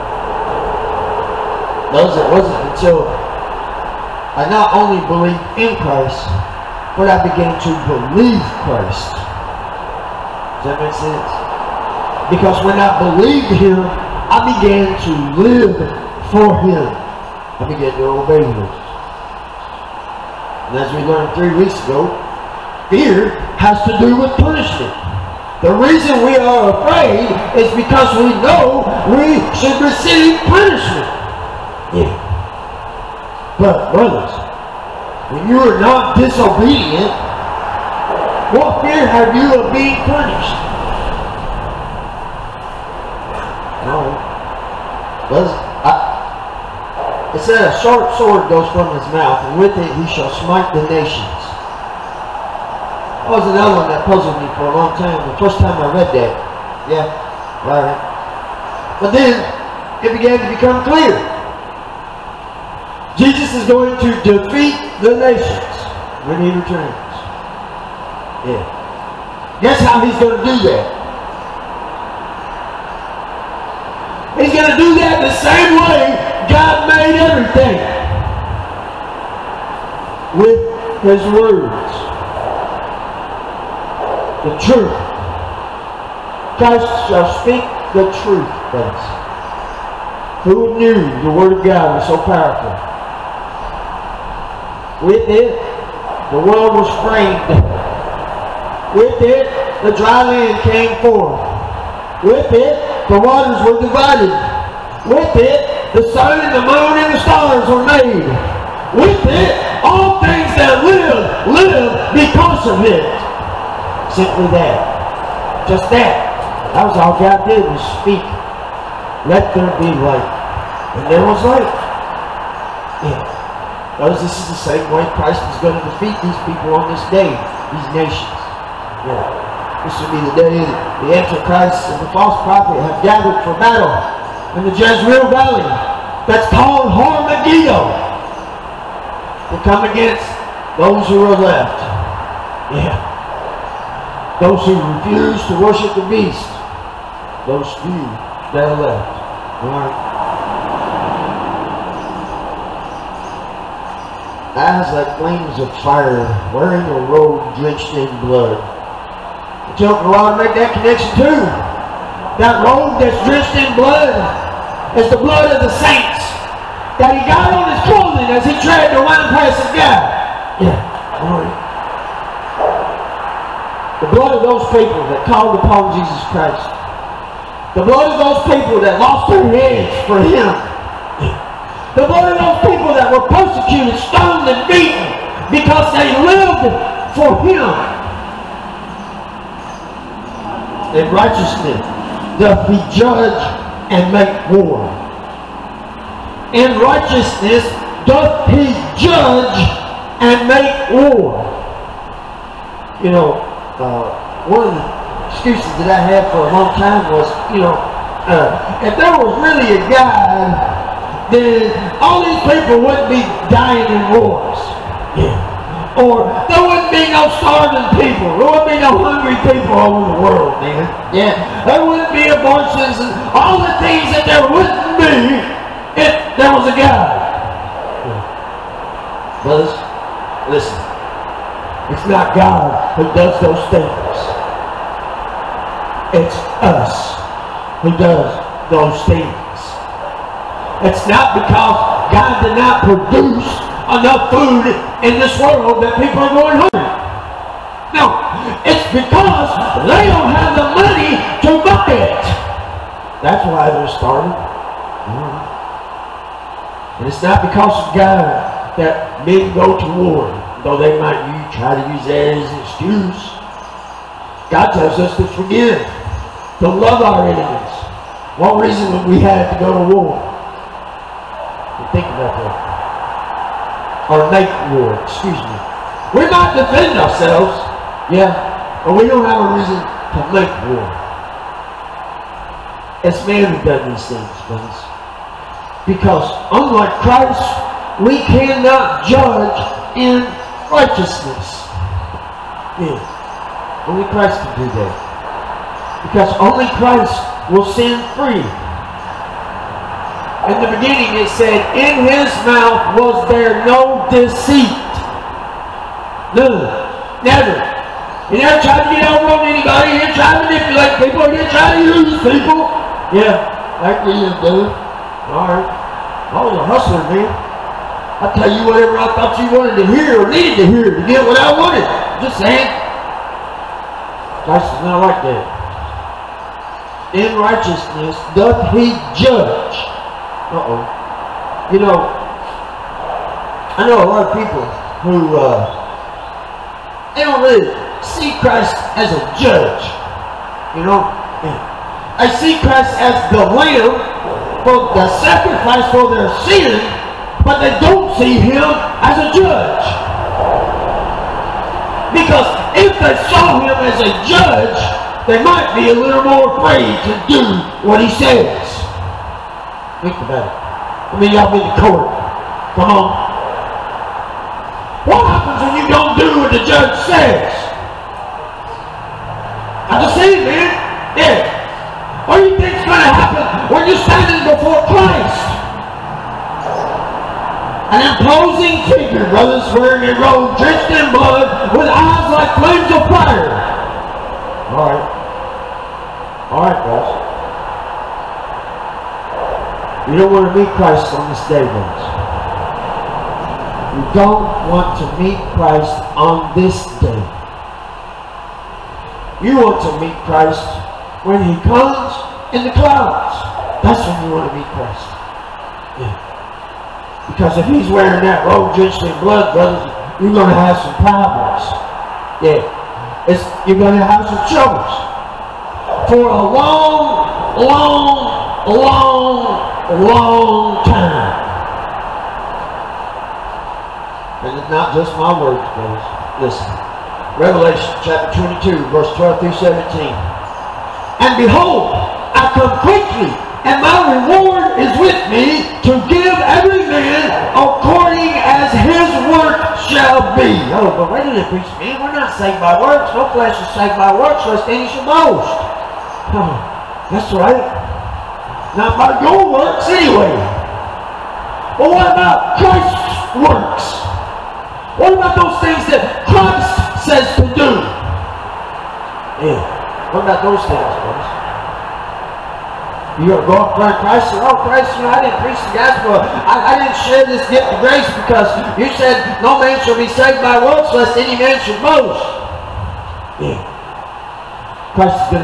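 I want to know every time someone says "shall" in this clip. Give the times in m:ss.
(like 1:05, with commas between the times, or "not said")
0:50, 1:27, 7:19, 7:49.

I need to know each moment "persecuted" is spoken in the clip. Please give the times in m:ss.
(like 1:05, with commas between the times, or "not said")
3:03.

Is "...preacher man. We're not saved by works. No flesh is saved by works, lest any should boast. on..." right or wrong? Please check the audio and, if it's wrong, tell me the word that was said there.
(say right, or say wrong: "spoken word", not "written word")
right.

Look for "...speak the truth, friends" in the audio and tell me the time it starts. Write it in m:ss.
1:27.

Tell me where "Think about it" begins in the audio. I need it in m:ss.
6:00.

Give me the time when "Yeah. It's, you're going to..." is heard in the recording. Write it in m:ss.
6:52.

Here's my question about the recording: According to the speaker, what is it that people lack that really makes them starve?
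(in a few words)
money.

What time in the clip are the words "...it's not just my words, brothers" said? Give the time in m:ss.
7:04.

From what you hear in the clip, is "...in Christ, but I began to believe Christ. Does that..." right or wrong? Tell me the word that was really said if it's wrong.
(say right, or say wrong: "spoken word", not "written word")
right.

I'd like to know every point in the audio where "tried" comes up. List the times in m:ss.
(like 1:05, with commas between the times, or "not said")
2:48, 5:08.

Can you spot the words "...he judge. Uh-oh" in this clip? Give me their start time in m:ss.
5:28.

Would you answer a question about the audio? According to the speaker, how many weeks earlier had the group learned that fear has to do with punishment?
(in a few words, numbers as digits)
3 weeks.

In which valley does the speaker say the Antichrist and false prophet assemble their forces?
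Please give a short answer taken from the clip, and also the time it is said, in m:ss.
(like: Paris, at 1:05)
Jezreel Valley, at 2:14.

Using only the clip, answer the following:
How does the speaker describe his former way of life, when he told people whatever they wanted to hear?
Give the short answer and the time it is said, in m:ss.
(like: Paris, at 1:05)
a hustler, at 5:16.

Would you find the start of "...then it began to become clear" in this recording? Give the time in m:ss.
0:59.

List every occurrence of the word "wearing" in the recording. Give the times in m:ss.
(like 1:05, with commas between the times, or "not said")
2:36, 6:19, 6:47.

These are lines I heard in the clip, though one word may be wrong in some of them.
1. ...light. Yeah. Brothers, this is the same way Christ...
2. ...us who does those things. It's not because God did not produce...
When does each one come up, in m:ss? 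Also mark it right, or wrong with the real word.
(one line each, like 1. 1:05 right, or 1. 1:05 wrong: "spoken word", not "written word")
1. 2:01 right
2. 3:56 right.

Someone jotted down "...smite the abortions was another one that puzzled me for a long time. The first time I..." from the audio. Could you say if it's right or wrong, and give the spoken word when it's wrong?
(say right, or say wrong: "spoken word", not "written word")
wrong: "nations", not "abortions".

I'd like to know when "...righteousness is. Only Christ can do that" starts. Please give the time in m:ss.
4:50.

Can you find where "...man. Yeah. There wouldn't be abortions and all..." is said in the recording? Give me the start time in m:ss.
3:40.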